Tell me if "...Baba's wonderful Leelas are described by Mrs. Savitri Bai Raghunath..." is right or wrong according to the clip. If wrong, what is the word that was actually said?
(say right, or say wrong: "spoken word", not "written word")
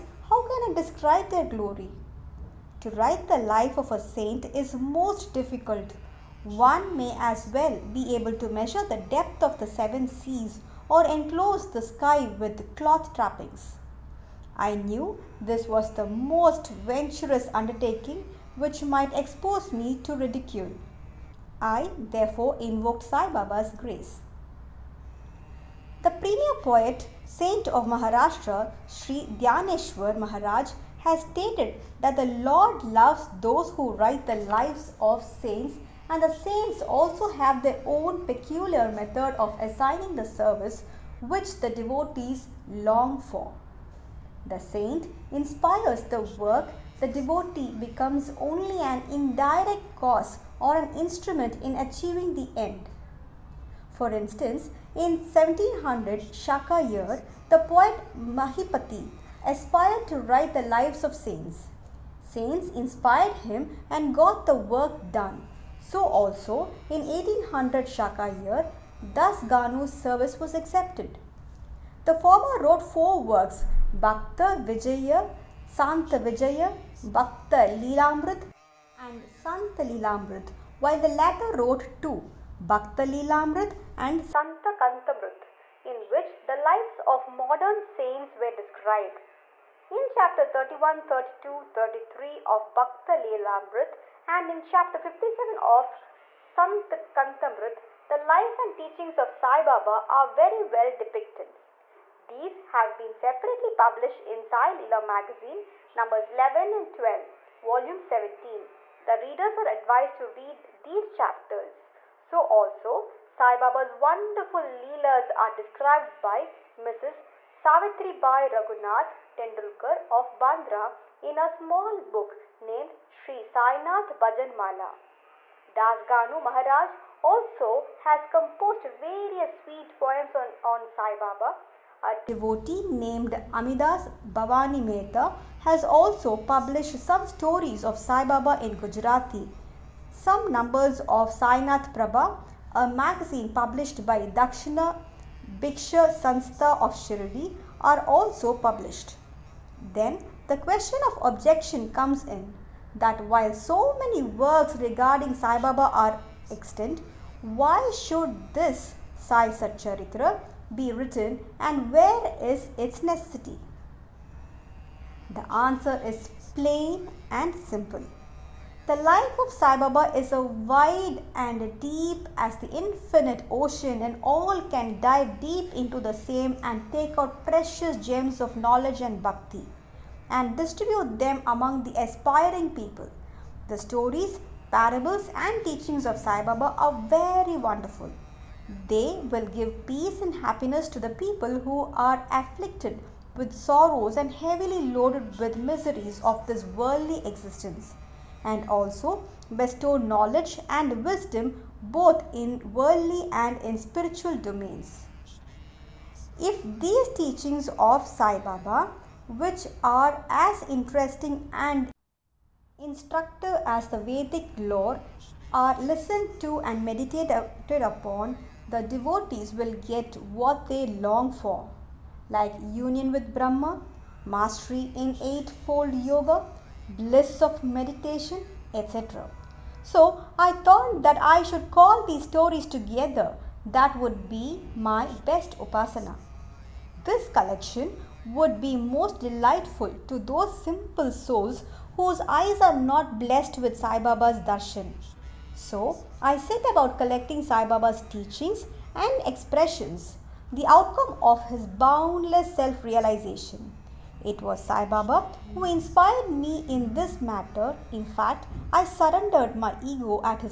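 right.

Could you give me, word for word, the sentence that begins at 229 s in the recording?
So I thought that I should call these stories together.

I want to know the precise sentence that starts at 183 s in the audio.
The stories, parables, and teachings of Sai Baba are very wonderful.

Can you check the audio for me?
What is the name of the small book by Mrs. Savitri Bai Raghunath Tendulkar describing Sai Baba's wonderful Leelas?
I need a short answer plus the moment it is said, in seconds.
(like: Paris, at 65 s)
Sri Sainath Bhajanmala, at 123 s.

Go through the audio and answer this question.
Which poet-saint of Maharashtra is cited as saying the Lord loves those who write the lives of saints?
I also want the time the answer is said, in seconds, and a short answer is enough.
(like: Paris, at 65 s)
Sri Dhyaneshwar Maharaj, at 28 s.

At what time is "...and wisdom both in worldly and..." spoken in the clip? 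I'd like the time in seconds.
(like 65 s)
200 s.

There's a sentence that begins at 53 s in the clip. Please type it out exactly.
For instance, in 1700 Shaka year, the poet Mahipati aspired to write the lives of saints.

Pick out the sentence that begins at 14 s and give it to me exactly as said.
I knew this was the most venturous undertaking which might expose me to ridicule.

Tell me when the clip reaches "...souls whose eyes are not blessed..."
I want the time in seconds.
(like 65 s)
241 s.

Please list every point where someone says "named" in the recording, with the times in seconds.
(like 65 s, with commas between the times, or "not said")
122 s, 132 s.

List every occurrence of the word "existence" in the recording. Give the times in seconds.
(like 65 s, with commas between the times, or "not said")
197 s.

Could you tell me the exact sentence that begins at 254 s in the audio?
It was Sai Baba who inspired me in this matter.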